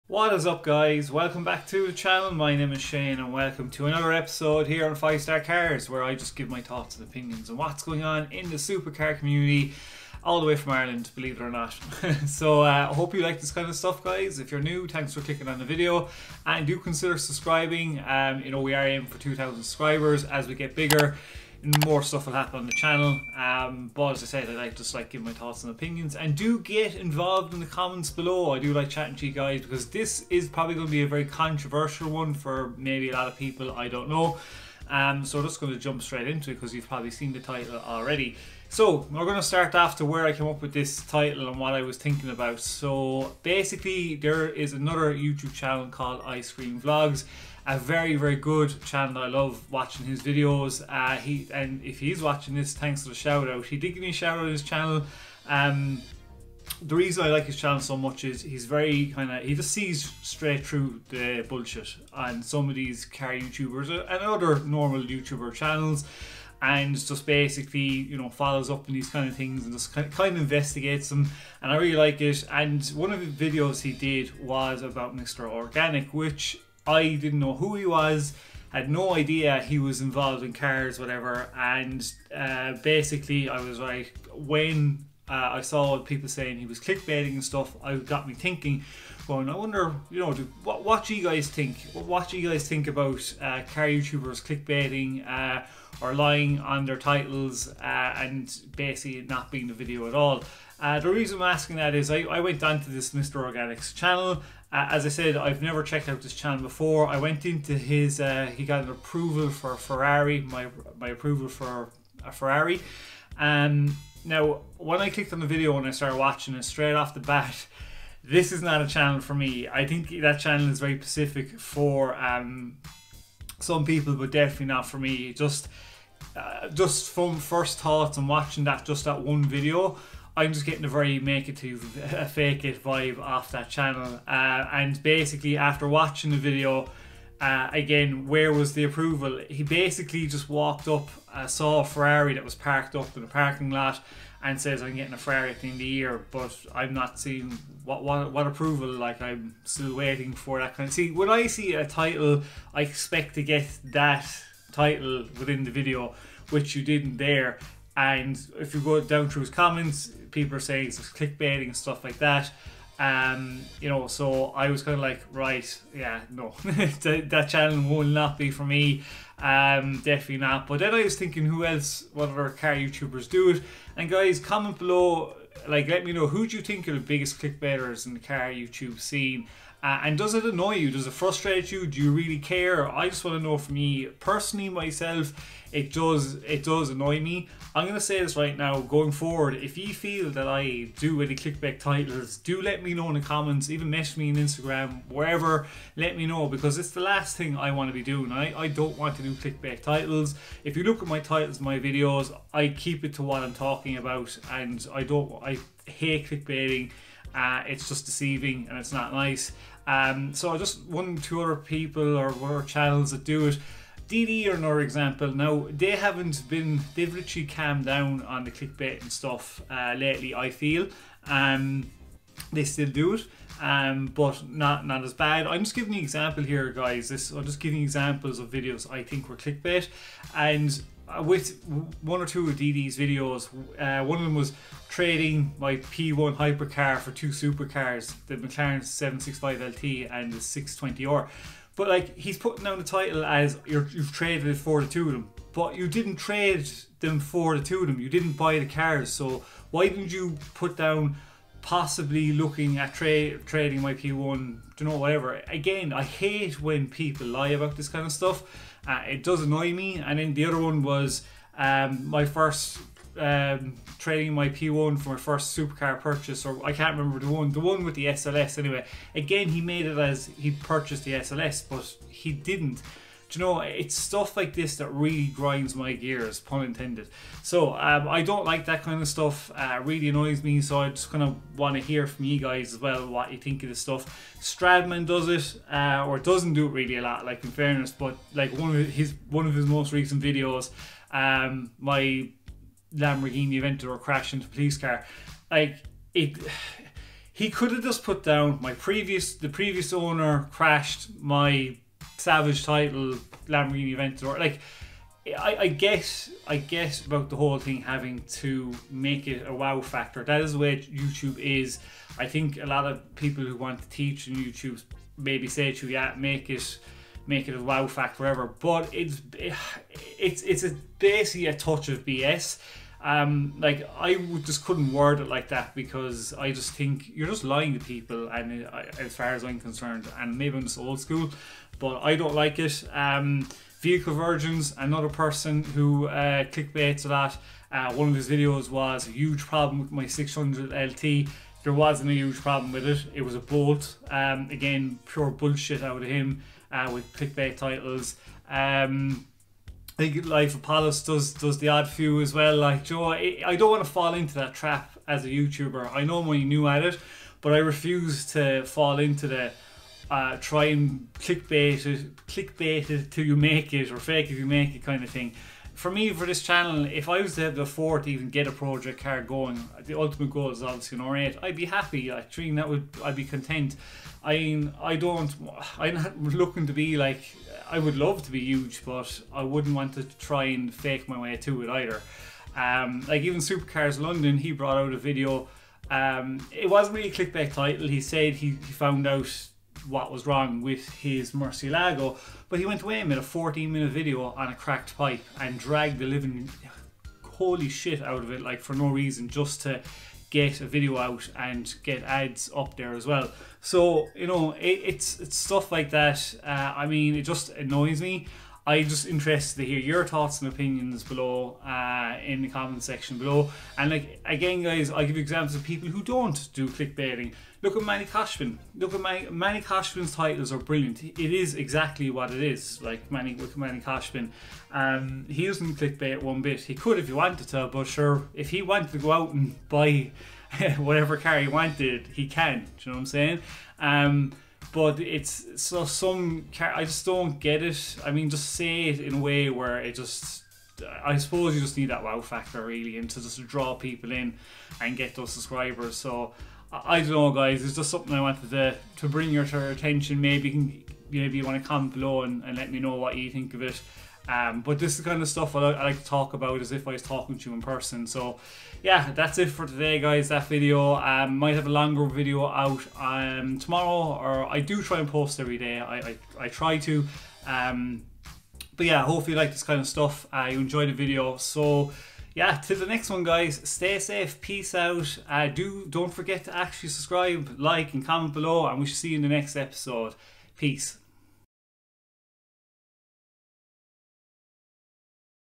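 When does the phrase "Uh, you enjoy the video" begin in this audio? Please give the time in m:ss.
7:50.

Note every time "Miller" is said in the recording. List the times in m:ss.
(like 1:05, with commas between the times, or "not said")
not said.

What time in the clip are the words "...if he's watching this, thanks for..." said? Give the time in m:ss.
0:51.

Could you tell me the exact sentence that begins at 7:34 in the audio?
Um, but this is kind of stuff I, I, like to talk about as if I was talking to you in person.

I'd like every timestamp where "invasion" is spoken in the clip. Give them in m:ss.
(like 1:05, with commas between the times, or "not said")
not said.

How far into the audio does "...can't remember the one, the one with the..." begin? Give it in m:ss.
4:26.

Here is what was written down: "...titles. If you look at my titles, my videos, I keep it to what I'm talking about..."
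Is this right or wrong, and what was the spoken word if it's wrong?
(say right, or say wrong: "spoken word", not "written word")
right.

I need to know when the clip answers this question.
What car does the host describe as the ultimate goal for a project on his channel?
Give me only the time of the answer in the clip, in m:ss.
6:11.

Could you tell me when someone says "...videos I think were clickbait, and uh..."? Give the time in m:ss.
3:48.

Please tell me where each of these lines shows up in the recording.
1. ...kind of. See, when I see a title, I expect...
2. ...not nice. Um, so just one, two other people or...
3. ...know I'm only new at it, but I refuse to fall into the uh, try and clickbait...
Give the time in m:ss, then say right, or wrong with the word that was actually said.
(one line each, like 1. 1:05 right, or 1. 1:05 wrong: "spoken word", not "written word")
1. 2:30 right
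2. 3:28 right
3. 5:56 right.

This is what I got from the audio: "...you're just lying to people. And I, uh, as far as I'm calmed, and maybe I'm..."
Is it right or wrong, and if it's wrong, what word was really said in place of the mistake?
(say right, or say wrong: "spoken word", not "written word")
wrong: "concerned", not "calmed".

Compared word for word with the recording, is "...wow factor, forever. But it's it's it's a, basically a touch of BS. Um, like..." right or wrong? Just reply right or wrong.
right.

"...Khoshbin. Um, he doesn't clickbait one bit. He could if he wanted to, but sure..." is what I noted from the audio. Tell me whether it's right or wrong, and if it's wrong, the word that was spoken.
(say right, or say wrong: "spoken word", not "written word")
right.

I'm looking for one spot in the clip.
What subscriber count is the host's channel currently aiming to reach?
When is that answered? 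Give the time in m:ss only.
0:19.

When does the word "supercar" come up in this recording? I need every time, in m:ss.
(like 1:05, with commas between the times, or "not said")
0:08, 3:57, 4:25, 6:23.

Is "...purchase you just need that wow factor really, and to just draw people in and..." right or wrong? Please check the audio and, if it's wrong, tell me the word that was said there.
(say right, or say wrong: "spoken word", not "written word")
wrong: "suppose", not "purchase".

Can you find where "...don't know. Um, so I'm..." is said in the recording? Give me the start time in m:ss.
0:33.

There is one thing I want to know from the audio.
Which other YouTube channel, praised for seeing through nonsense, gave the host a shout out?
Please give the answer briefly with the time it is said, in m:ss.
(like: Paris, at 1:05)
Ice Cream Vlogs, at 0:46.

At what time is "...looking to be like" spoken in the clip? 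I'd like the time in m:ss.
6:16.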